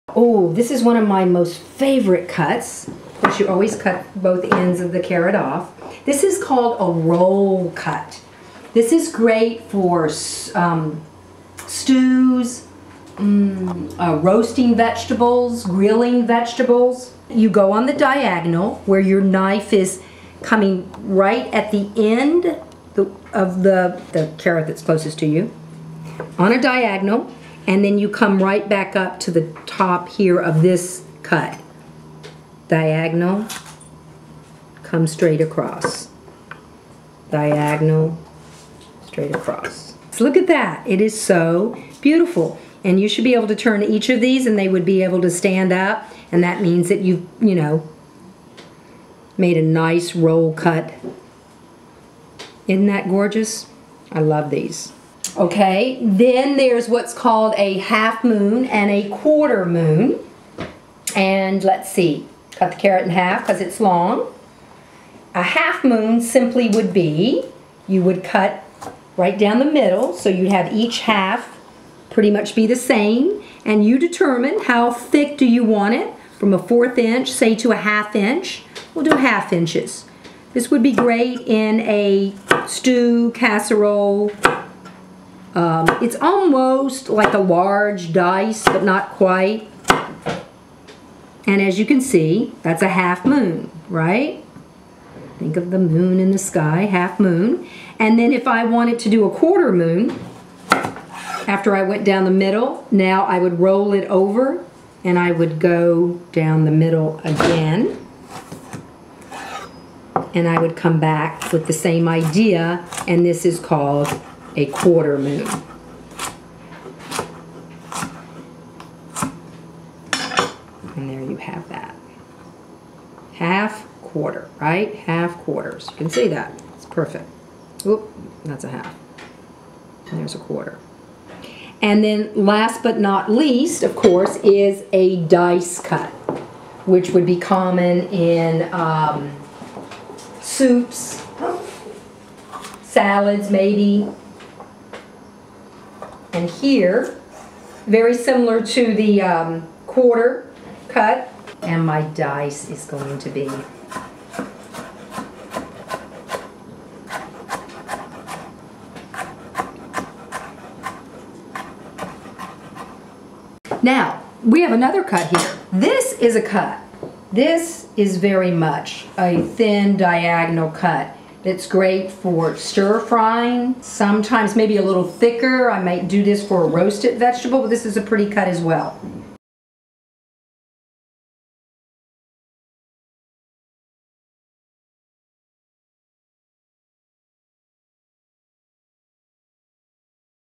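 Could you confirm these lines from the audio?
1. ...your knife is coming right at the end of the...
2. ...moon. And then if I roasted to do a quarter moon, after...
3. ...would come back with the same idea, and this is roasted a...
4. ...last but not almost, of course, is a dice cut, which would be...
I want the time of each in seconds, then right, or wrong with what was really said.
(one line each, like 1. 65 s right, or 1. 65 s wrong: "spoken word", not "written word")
1. 18 s right
2. 97 s wrong: "wanted", not "roasted"
3. 110 s wrong: "called", not "roasted"
4. 132 s wrong: "least", not "almost".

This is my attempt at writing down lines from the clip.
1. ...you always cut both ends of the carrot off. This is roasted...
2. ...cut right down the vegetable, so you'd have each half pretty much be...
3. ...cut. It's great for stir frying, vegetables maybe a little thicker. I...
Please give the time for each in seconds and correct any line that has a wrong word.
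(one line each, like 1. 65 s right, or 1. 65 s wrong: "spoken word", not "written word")
1. 3 s wrong: "called", not "roasted"
2. 68 s wrong: "middle", not "vegetable"
3. 170 s wrong: "sometimes", not "vegetables".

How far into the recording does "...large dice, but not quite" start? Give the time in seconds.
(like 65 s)
87 s.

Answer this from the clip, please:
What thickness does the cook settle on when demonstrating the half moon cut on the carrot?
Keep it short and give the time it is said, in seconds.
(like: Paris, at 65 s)
half inches, at 79 s.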